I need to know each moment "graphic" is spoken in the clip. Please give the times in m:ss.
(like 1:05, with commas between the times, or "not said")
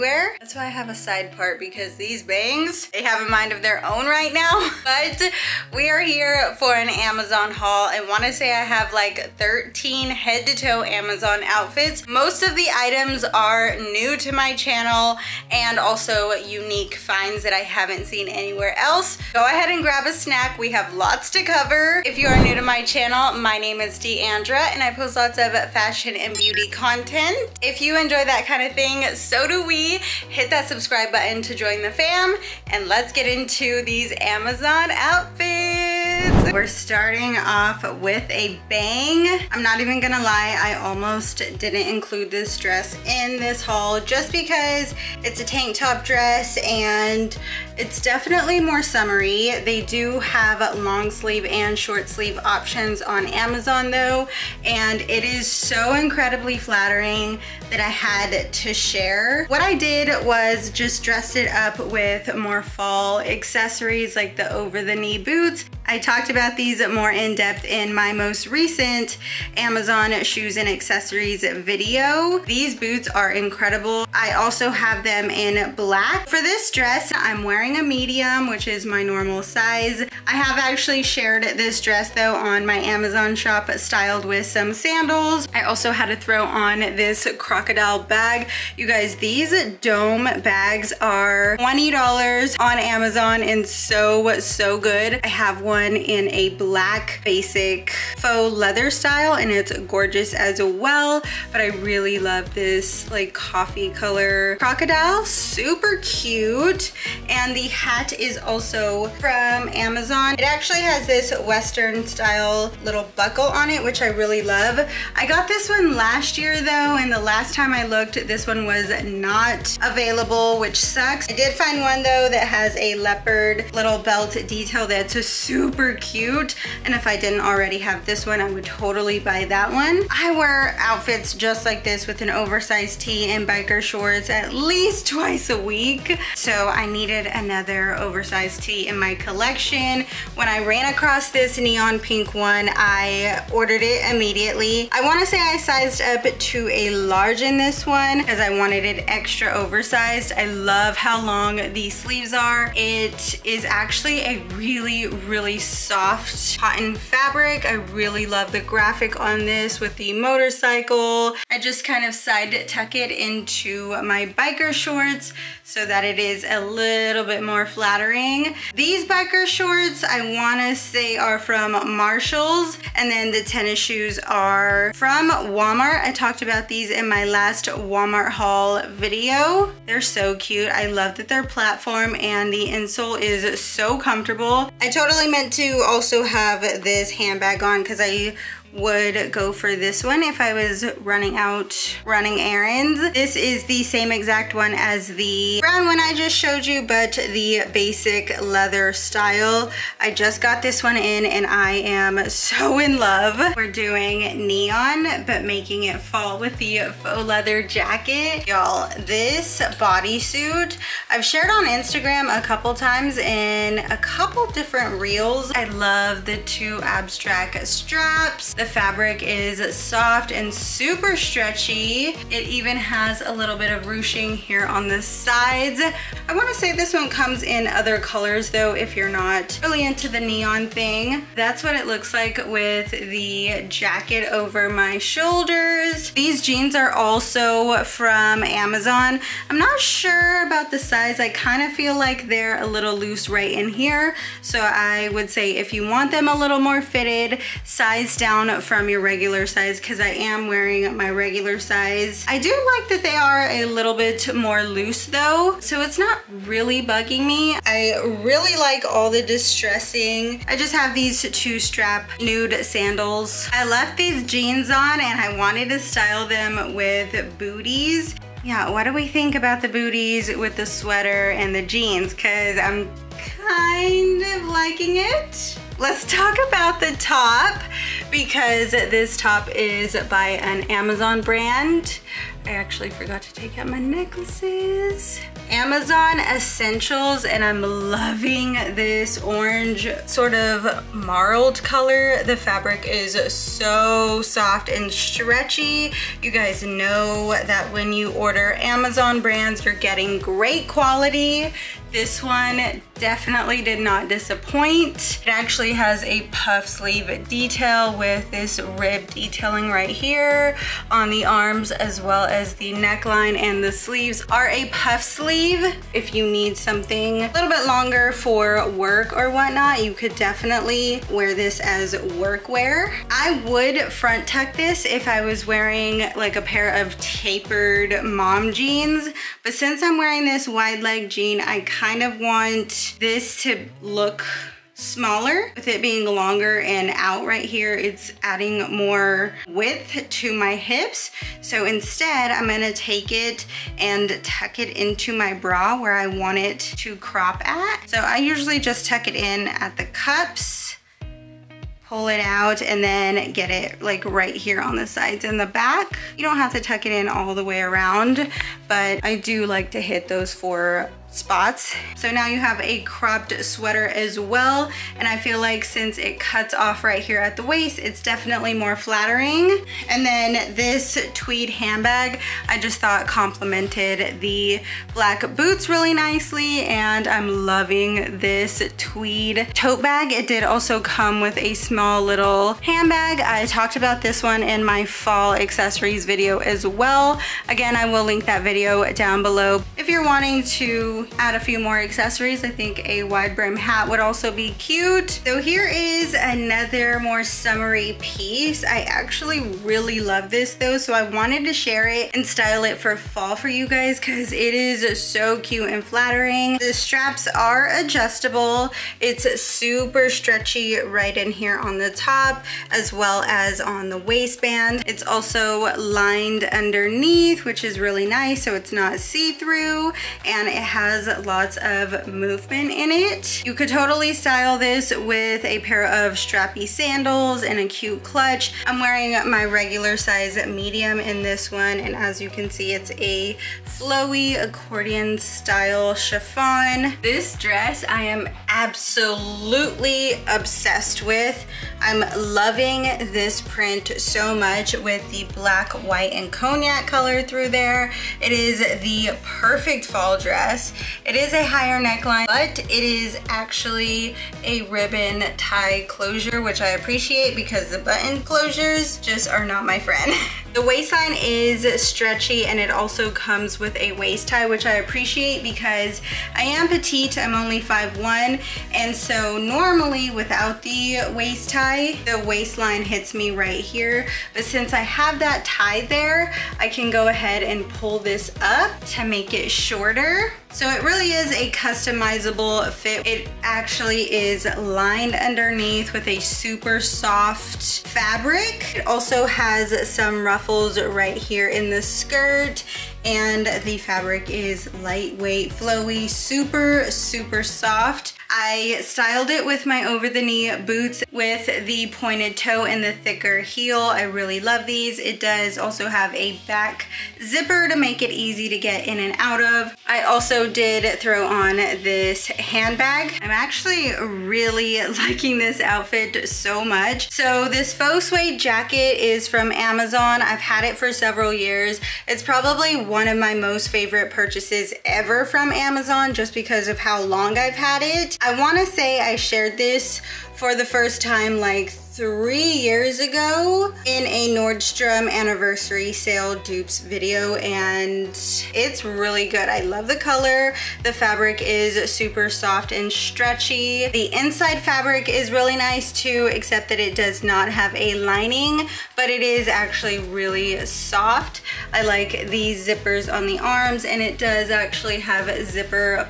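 2:38.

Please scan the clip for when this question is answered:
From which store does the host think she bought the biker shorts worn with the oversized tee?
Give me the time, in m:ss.
2:51.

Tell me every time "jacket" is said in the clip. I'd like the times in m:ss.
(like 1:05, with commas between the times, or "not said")
3:27, 3:53, 8:38.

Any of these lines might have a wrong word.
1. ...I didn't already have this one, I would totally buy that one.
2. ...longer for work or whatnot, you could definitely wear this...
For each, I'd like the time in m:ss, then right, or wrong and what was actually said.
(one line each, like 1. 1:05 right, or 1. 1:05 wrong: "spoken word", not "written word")
1. 2:07 right
2. 5:17 right.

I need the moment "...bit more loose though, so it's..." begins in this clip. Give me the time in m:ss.
4:13.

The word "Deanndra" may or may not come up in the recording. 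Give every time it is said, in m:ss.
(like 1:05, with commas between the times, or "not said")
0:23.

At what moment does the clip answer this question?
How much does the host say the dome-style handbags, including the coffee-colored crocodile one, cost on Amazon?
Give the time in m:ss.
1:31.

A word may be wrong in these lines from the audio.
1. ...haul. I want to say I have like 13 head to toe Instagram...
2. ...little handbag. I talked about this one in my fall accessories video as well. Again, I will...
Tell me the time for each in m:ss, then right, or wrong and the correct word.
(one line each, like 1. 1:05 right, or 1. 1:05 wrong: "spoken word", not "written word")
1. 0:07 wrong: "Amazon", not "Instagram"
2. 6:22 right.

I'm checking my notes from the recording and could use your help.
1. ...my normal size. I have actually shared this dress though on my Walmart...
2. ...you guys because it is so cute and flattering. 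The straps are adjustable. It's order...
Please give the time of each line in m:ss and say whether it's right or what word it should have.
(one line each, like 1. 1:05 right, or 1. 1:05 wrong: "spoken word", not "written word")
1. 1:18 wrong: "Amazon", not "Walmart"
2. 6:43 wrong: "super", not "order".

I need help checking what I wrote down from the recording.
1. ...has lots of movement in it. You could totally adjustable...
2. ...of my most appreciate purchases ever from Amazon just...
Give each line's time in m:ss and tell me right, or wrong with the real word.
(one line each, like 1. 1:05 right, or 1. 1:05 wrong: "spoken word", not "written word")
1. 7:00 wrong: "style", not "adjustable"
2. 8:43 wrong: "favorite", not "appreciate".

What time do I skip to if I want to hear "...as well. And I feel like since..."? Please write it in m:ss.
6:03.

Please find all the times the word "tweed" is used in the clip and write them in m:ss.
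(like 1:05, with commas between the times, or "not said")
6:11, 6:18.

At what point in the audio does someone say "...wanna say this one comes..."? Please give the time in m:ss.
3:46.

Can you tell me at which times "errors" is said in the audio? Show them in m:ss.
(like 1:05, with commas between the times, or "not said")
not said.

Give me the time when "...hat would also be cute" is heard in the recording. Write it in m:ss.
6:33.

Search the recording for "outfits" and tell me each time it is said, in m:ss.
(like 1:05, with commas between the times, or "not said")
0:11, 0:34, 2:10, 8:35.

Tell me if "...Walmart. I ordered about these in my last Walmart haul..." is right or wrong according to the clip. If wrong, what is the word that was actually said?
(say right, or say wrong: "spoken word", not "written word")
wrong: "talked", not "ordered".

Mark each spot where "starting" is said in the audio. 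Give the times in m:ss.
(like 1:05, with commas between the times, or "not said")
0:36.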